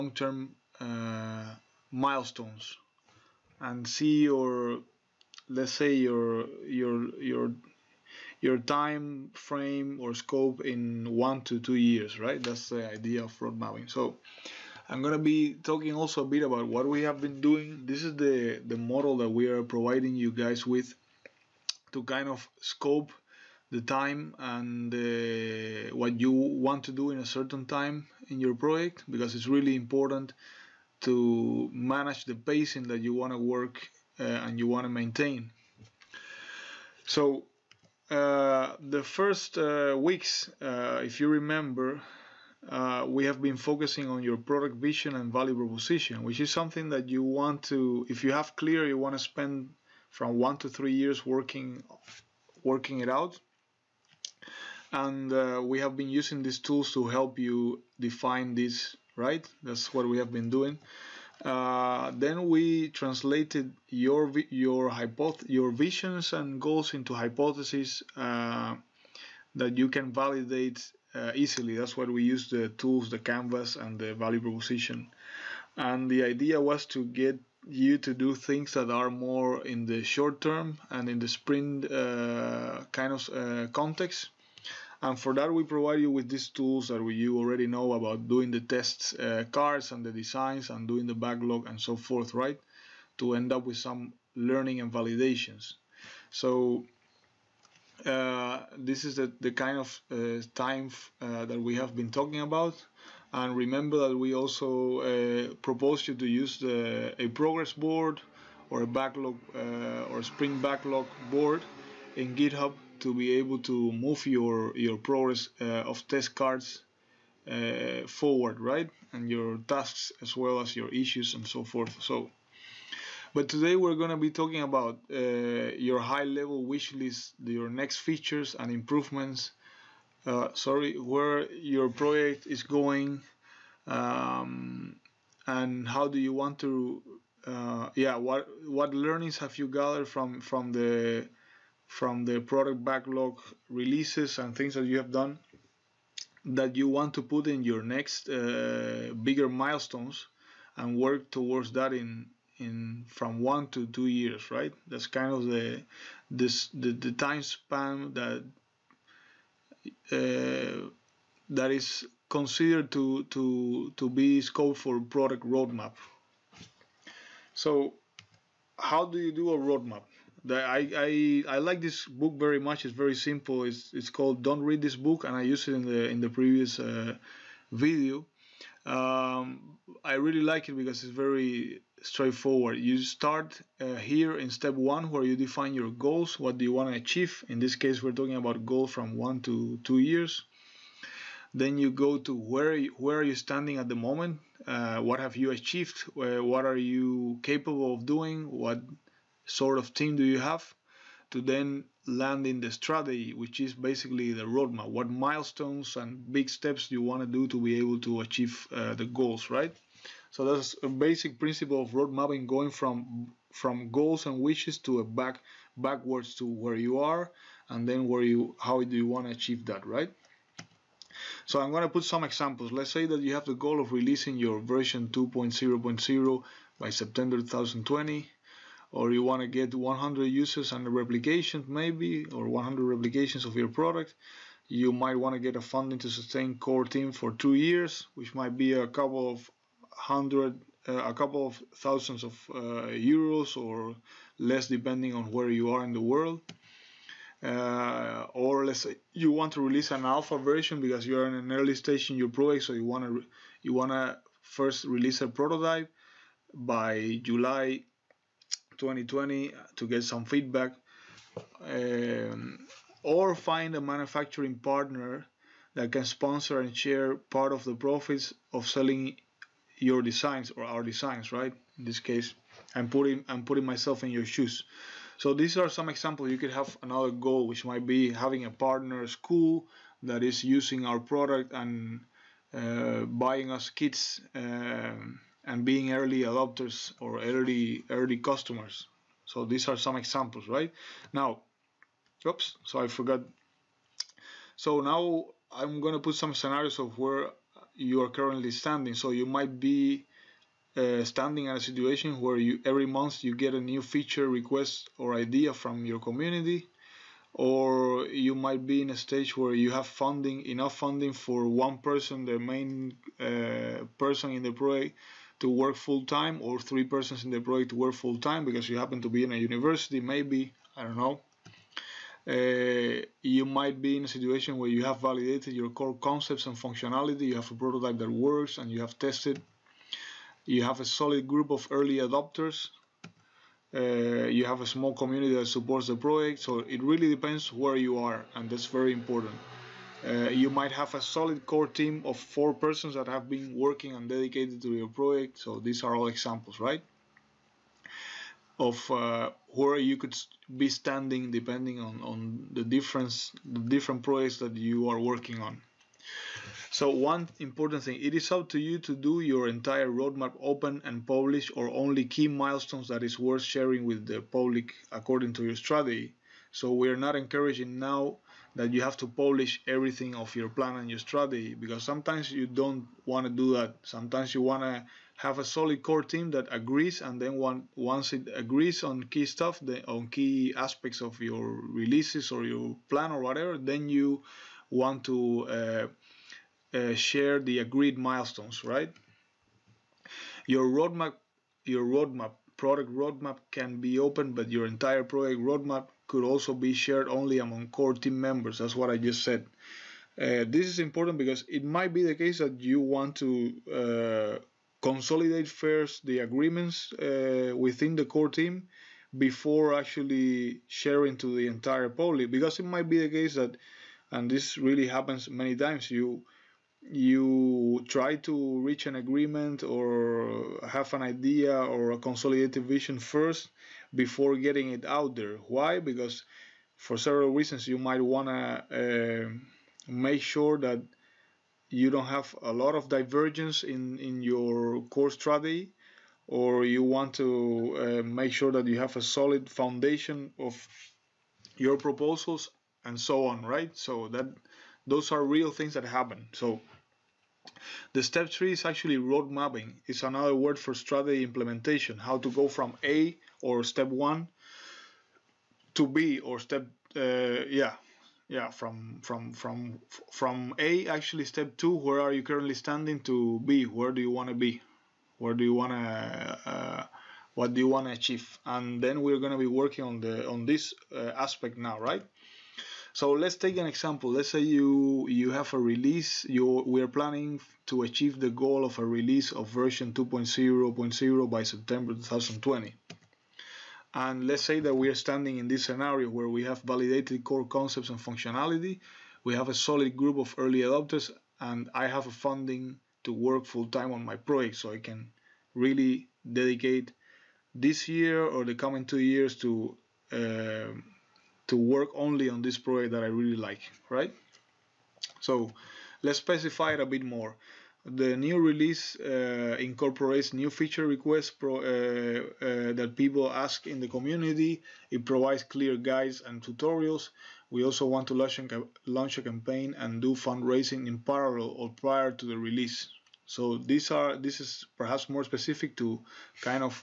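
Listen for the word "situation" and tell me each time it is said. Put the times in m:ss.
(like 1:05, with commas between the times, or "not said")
5:01, 5:24.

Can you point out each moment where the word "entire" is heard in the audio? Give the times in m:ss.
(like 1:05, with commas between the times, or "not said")
5:59, 6:34, 6:51.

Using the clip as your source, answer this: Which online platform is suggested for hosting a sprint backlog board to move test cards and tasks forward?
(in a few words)
GitHub.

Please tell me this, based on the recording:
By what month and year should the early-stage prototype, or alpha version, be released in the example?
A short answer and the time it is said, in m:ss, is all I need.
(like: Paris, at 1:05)
July 2020, at 4:17.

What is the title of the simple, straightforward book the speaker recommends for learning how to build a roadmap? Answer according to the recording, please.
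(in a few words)
Don't Read This Book.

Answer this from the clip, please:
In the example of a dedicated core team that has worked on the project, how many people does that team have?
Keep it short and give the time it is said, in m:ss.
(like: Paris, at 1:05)
4, at 5:42.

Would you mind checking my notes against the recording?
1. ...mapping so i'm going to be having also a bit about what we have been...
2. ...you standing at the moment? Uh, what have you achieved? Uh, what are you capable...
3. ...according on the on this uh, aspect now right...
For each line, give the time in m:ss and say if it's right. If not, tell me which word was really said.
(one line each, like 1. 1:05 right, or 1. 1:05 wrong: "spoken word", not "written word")
1. 0:13 wrong: "talking", not "having"
2. 3:13 right
3. 7:49 wrong: "working", not "according".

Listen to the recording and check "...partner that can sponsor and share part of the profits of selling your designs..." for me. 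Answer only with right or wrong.
right.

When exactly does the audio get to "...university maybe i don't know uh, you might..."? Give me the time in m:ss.
5:19.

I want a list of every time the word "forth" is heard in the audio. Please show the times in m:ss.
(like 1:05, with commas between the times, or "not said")
1:31, 2:01.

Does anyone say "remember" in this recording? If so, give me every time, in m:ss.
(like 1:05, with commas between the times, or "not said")
0:41, 1:43.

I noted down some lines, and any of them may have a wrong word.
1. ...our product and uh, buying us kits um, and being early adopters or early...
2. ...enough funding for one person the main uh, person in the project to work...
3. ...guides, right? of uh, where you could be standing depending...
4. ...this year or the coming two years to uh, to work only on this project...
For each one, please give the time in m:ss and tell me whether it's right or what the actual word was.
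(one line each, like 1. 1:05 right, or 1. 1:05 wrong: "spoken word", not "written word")
1. 4:40 right
2. 5:10 right
3. 5:46 wrong: "examples", not "guides"
4. 8:17 right.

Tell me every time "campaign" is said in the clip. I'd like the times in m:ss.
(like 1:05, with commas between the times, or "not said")
8:39.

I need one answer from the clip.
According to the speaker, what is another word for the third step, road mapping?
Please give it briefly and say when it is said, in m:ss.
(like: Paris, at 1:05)
strategy implementation, at 7:30.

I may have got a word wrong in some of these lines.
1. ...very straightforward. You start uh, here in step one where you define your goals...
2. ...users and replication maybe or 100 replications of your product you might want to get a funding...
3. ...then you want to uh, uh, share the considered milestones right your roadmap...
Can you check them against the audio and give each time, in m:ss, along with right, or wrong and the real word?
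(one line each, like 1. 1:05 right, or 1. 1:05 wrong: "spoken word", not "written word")
1. 3:01 right
2. 3:50 right
3. 6:23 wrong: "agreed", not "considered".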